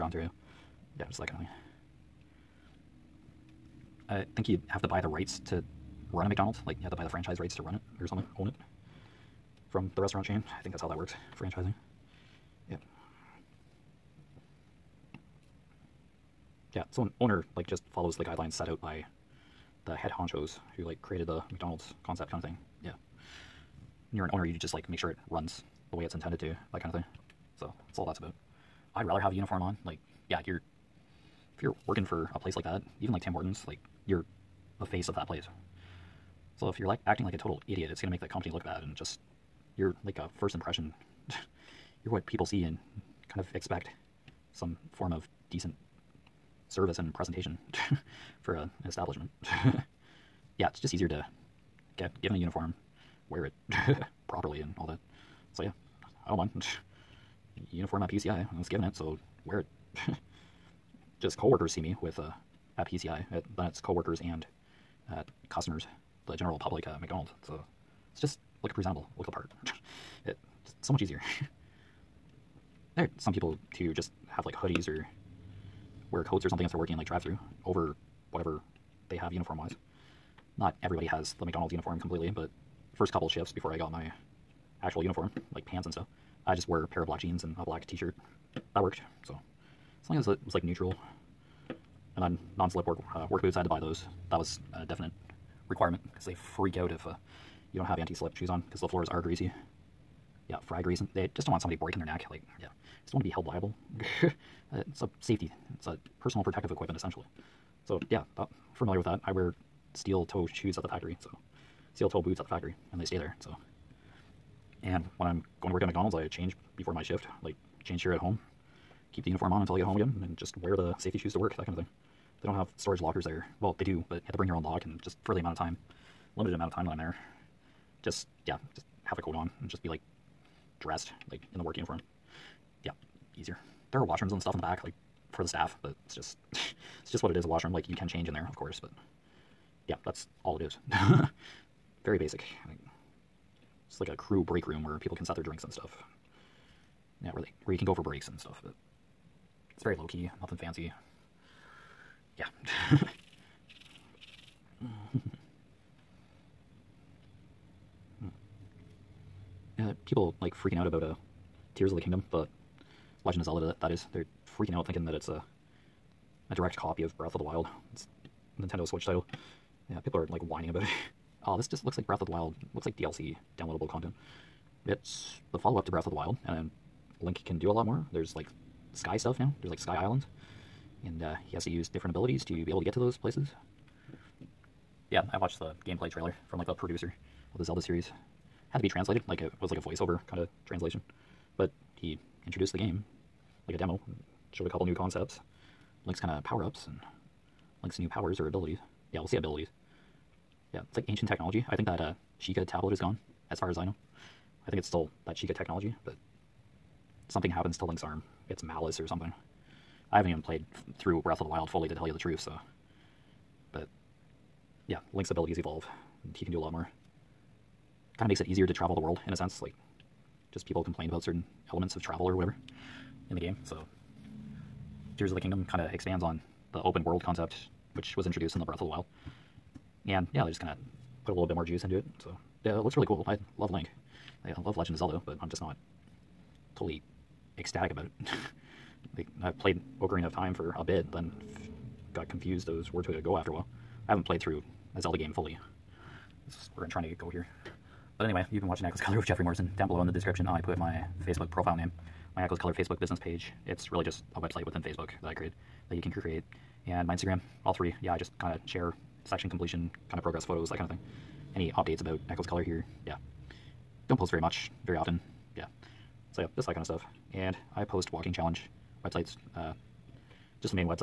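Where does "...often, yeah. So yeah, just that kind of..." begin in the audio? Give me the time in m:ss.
4:24.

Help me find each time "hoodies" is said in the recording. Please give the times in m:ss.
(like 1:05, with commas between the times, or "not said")
1:14.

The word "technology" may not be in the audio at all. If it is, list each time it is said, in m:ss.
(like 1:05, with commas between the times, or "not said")
3:21, 3:25.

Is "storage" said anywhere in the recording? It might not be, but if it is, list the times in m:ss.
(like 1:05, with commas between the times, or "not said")
2:02.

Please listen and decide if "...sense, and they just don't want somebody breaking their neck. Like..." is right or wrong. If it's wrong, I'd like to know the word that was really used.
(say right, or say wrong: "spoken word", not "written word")
wrong: "grease", not "sense".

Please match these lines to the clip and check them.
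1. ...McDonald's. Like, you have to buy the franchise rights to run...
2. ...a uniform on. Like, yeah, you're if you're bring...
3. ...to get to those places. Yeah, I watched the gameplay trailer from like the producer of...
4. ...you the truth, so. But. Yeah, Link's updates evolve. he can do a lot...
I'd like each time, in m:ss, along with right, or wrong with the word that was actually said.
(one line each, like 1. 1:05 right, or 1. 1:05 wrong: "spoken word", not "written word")
1. 0:06 right
2. 0:29 wrong: "working", not "bring"
3. 3:02 right
4. 3:32 wrong: "abilities", not "updates".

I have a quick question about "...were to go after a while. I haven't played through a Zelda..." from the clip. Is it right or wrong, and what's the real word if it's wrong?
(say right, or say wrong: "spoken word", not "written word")
right.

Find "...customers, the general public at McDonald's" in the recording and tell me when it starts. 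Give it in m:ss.
1:05.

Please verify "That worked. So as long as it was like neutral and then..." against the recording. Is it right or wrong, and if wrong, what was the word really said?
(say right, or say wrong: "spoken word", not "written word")
right.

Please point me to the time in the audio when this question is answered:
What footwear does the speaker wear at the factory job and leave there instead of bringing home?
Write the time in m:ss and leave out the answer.
1:51.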